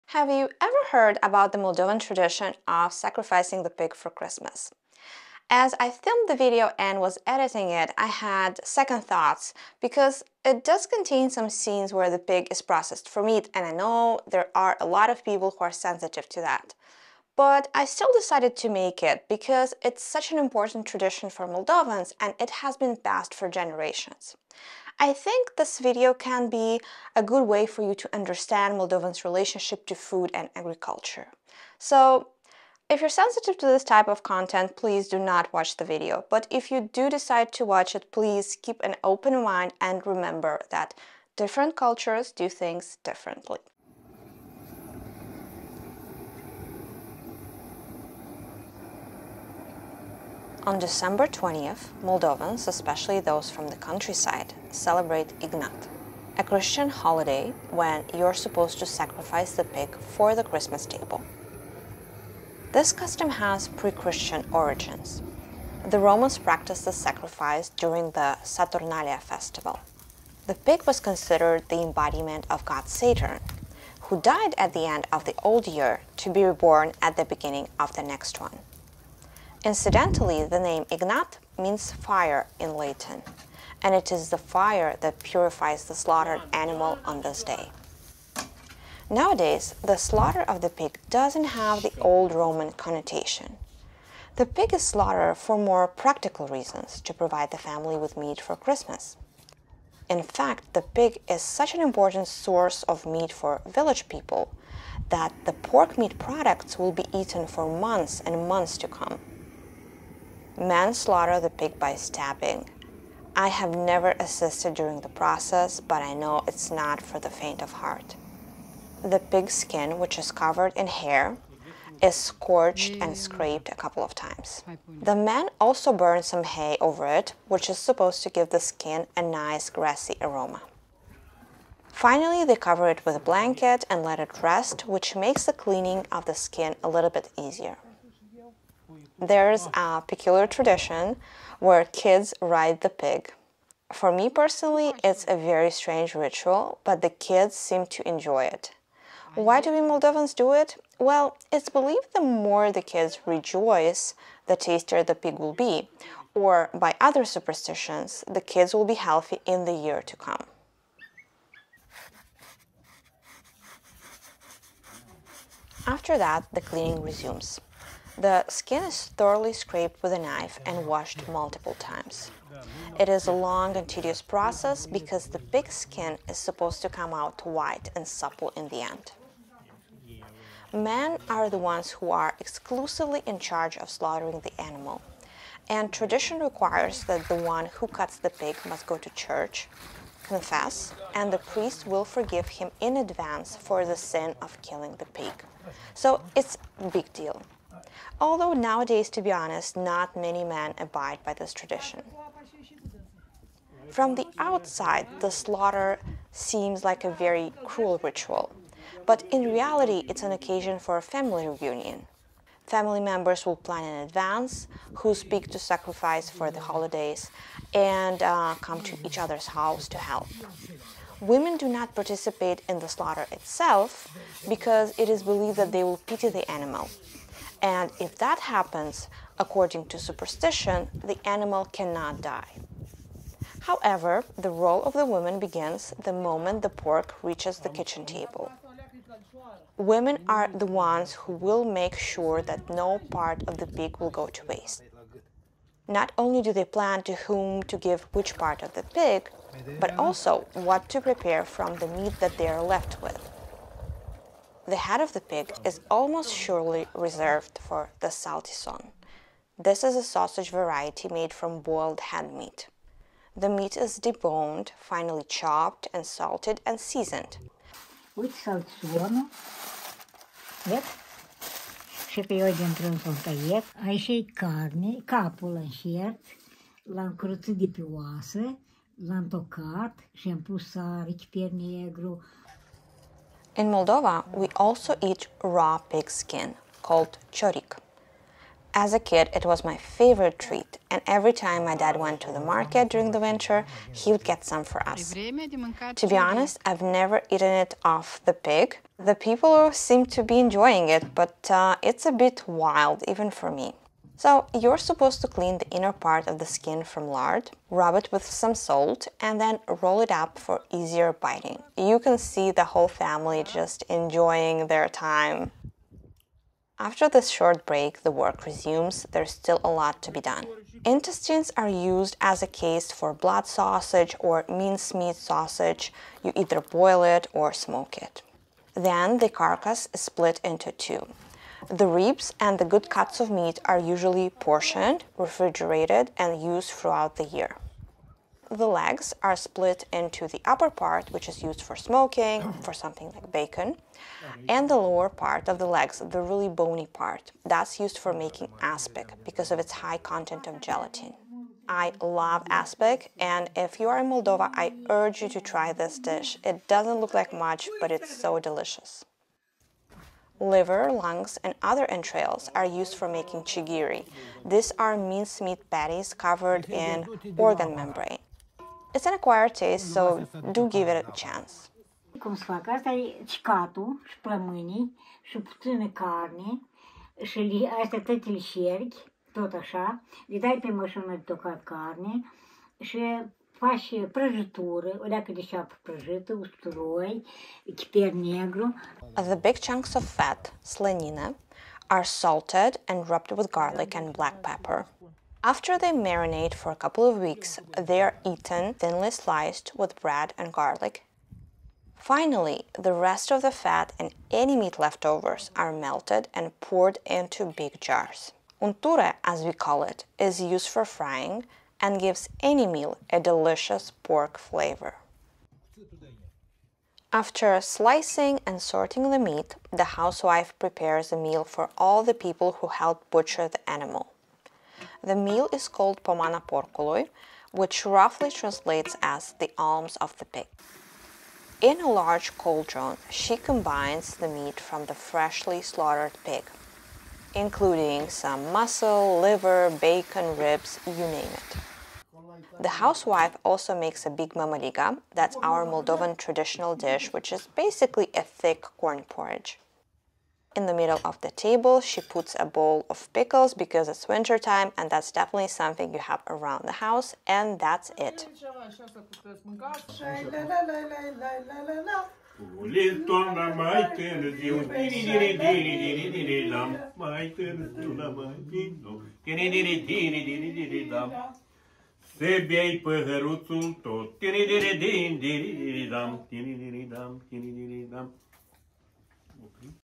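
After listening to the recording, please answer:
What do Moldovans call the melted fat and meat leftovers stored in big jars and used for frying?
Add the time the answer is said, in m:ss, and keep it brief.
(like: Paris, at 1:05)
Unture, at 6:48.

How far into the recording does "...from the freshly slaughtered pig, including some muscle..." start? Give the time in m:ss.
7:14.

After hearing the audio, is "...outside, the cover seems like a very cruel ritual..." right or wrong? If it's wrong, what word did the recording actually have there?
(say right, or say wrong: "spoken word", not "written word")
wrong: "slaughter", not "cover".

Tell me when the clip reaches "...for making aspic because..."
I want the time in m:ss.
5:47.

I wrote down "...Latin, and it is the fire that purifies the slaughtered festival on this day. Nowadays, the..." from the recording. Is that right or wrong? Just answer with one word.
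wrong.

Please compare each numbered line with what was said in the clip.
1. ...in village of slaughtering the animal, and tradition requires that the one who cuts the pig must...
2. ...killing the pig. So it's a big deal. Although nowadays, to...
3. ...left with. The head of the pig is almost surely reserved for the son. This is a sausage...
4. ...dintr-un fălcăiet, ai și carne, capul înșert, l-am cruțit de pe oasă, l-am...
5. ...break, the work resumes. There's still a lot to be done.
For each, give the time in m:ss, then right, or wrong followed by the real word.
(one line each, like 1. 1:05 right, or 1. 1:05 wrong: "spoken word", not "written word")
1. 3:03 wrong: "charge", not "village"
2. 3:14 right
3. 4:12 right
4. 4:32 right
5. 5:17 right.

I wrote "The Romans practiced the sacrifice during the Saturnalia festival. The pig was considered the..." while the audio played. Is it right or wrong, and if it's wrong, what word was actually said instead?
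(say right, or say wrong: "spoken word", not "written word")
right.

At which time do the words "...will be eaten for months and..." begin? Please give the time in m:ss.
1:46.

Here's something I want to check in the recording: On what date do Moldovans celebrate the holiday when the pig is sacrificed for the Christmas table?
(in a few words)
December 20th.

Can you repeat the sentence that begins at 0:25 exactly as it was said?
I think this video can be a good way for you to understand Moldovans' relationship to food and agriculture.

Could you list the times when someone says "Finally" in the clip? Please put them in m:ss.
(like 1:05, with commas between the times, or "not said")
2:11, 6:41.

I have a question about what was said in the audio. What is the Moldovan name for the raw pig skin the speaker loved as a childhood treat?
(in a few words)
Chorik.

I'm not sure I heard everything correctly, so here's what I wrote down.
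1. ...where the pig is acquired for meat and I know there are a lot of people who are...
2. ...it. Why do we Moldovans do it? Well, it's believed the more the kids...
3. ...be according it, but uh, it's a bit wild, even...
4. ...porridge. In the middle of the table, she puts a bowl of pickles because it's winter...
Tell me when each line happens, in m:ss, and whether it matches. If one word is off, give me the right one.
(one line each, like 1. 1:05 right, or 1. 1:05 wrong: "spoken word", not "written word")
1. 0:11 wrong: "processed", not "acquired"
2. 2:28 right
3. 5:00 wrong: "enjoying", not "according"
4. 7:29 right.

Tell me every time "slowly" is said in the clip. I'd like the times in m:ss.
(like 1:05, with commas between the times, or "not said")
not said.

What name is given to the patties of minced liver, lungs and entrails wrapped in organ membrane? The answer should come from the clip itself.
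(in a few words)
Chigiri.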